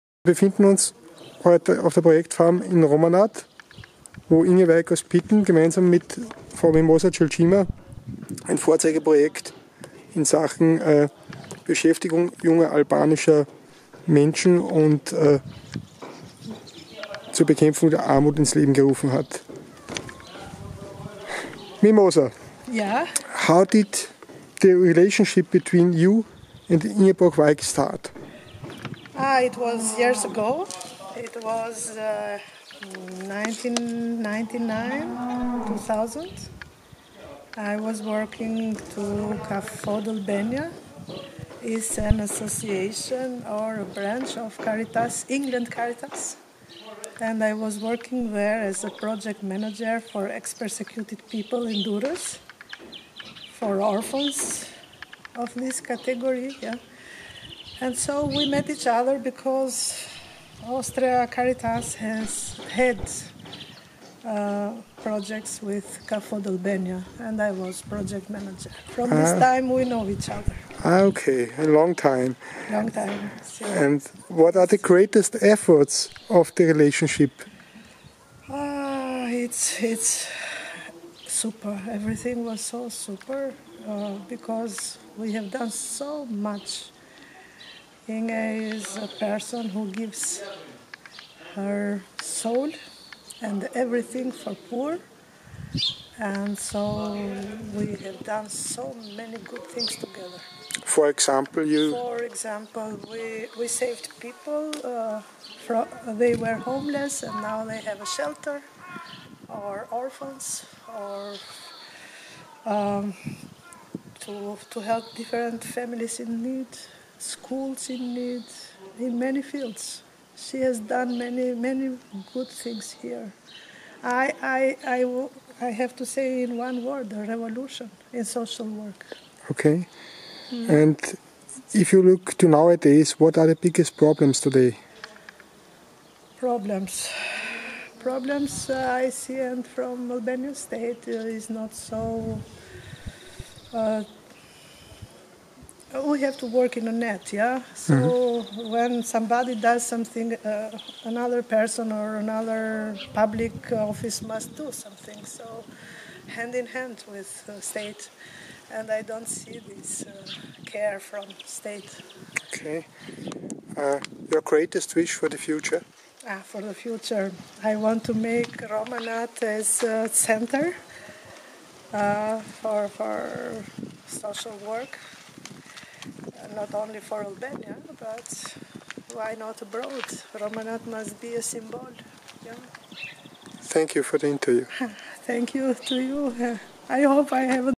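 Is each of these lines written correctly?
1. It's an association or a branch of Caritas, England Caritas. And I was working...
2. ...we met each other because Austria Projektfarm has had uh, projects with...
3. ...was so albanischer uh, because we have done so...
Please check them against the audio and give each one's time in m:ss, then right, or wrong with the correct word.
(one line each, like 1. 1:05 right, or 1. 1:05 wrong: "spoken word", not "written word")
1. 0:41 right
2. 0:58 wrong: "Caritas", not "Projektfarm"
3. 1:22 wrong: "super", not "albanischer".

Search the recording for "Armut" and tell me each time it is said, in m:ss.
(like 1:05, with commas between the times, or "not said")
0:18.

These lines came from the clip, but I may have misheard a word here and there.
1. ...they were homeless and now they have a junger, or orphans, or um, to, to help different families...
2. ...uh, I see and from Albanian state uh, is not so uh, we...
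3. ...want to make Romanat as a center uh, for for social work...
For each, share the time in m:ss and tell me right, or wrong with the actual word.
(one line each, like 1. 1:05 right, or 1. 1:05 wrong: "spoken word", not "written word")
1. 1:46 wrong: "shelter", not "junger"
2. 2:18 right
3. 2:47 right.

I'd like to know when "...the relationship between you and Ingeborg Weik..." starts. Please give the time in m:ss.
0:24.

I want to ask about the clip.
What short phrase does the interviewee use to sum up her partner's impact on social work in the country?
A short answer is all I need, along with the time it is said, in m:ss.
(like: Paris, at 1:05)
A revolution, at 2:07.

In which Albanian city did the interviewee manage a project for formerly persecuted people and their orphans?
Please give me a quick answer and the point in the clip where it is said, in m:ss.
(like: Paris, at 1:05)
Durres, at 0:51.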